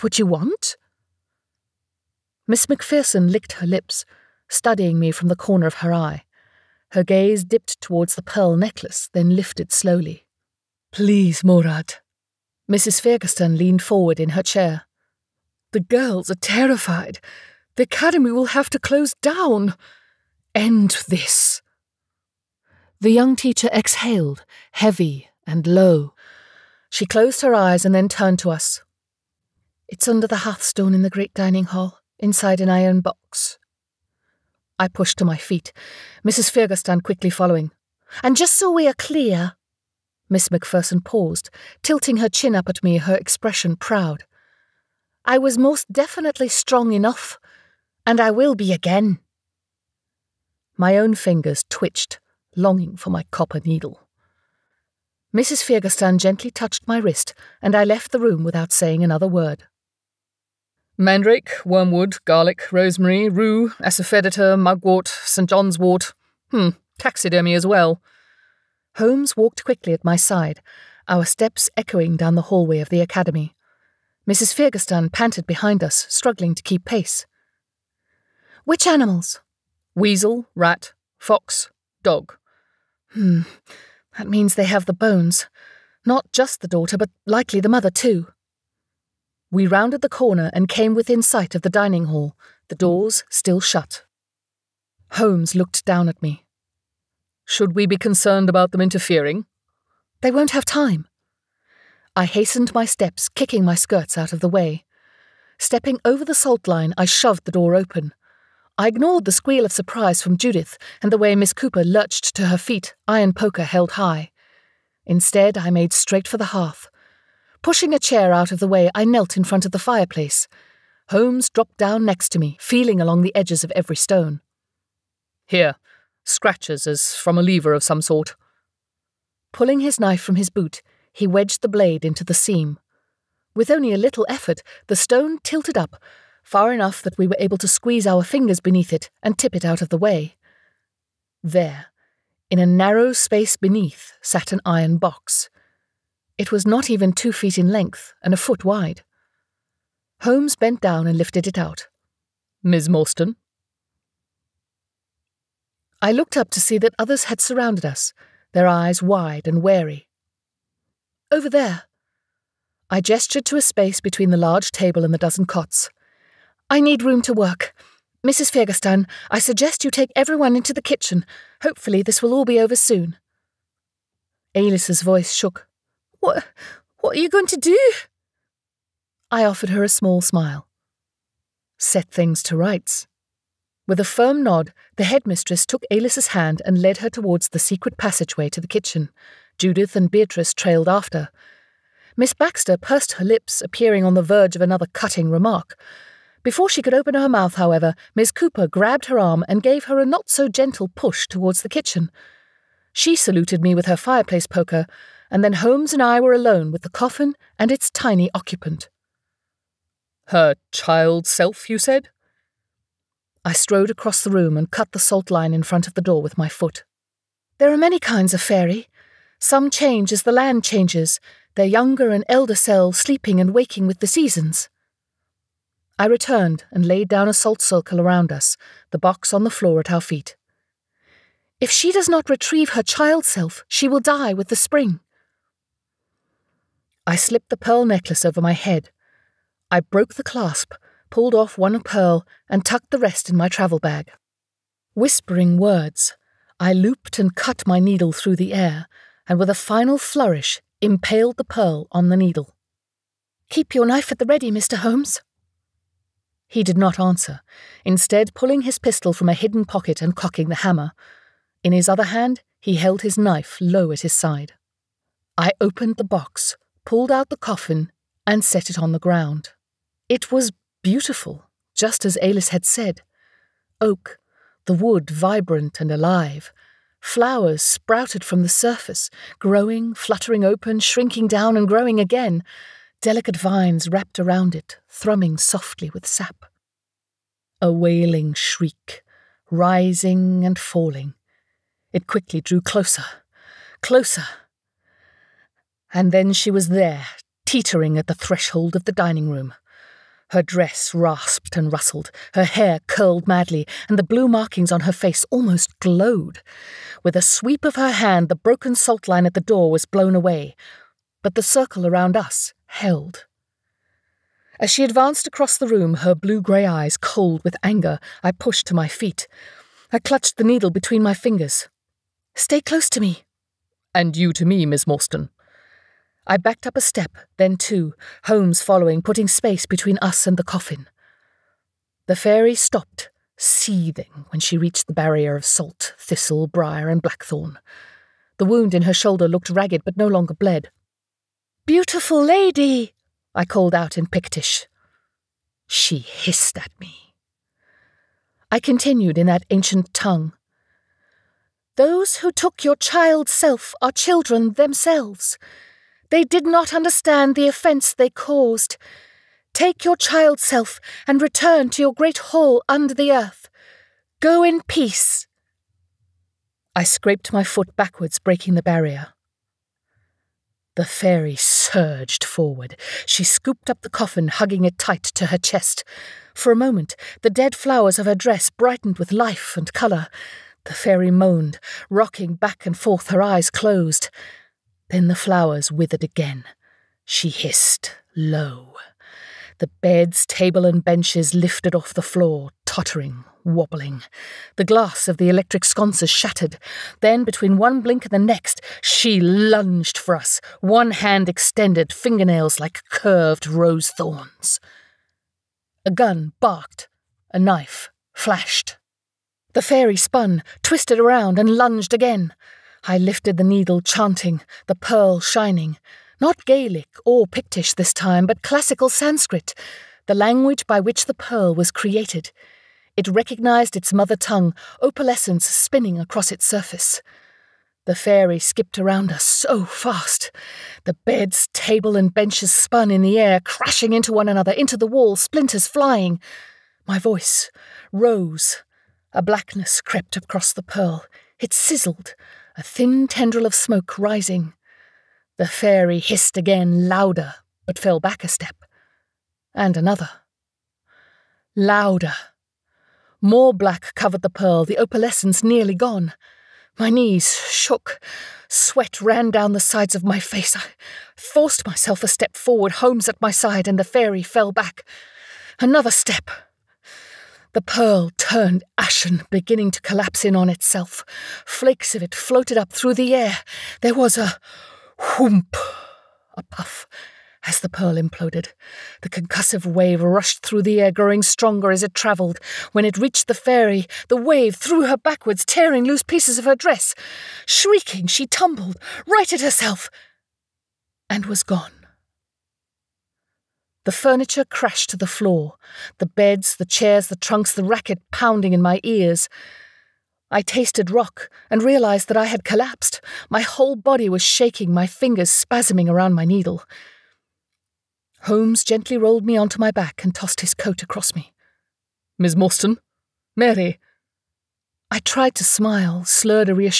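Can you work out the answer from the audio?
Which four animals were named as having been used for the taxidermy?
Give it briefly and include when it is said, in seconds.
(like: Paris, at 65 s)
Weasel, rat, fox, dog, at 79 s.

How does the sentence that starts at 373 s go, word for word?
She scooped up the coffin, hugging it tight to her chest.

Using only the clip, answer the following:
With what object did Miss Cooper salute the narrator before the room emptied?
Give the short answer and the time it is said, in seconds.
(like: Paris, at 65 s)
Fireplace poker, at 203 s.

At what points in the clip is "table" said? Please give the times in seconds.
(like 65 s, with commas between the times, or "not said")
164 s, 390 s, 431 s.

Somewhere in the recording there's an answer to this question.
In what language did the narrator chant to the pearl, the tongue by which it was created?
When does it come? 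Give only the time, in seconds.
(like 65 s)
418 s.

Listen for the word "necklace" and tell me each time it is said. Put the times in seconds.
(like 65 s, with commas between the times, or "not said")
8 s, 237 s.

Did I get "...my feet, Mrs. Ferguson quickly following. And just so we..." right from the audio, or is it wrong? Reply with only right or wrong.
right.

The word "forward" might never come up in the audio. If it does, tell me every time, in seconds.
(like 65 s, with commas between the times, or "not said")
13 s, 372 s, 462 s.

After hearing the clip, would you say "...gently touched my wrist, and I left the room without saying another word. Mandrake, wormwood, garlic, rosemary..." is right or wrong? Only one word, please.
right.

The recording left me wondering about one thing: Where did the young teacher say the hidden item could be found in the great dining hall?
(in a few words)
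Under the hearthstone.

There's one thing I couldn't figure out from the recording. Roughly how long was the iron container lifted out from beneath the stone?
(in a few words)
Not even two feet.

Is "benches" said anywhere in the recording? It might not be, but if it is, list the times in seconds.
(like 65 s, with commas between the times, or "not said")
390 s, 432 s.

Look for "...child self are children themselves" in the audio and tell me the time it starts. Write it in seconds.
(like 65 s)
352 s.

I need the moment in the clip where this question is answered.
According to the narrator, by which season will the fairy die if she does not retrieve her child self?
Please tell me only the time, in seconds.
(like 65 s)
234 s.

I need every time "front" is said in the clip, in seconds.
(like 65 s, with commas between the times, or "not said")
119 s, 215 s.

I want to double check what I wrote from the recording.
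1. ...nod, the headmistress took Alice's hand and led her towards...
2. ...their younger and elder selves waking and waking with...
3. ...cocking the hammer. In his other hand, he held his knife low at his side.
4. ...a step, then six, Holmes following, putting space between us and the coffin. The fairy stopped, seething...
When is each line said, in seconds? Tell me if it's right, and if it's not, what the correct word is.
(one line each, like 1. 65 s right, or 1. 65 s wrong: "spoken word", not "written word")
1. 184 s right
2. 221 s wrong: "sleeping", not "waking"
3. 260 s right
4. 326 s wrong: "two", not "six".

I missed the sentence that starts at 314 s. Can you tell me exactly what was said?
As she advanced across the room, her blue grey eyes cold with anger, I pushed to my feet.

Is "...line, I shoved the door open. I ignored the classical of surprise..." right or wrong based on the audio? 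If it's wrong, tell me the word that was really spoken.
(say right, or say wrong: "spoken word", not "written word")
wrong: "squeal", not "classical".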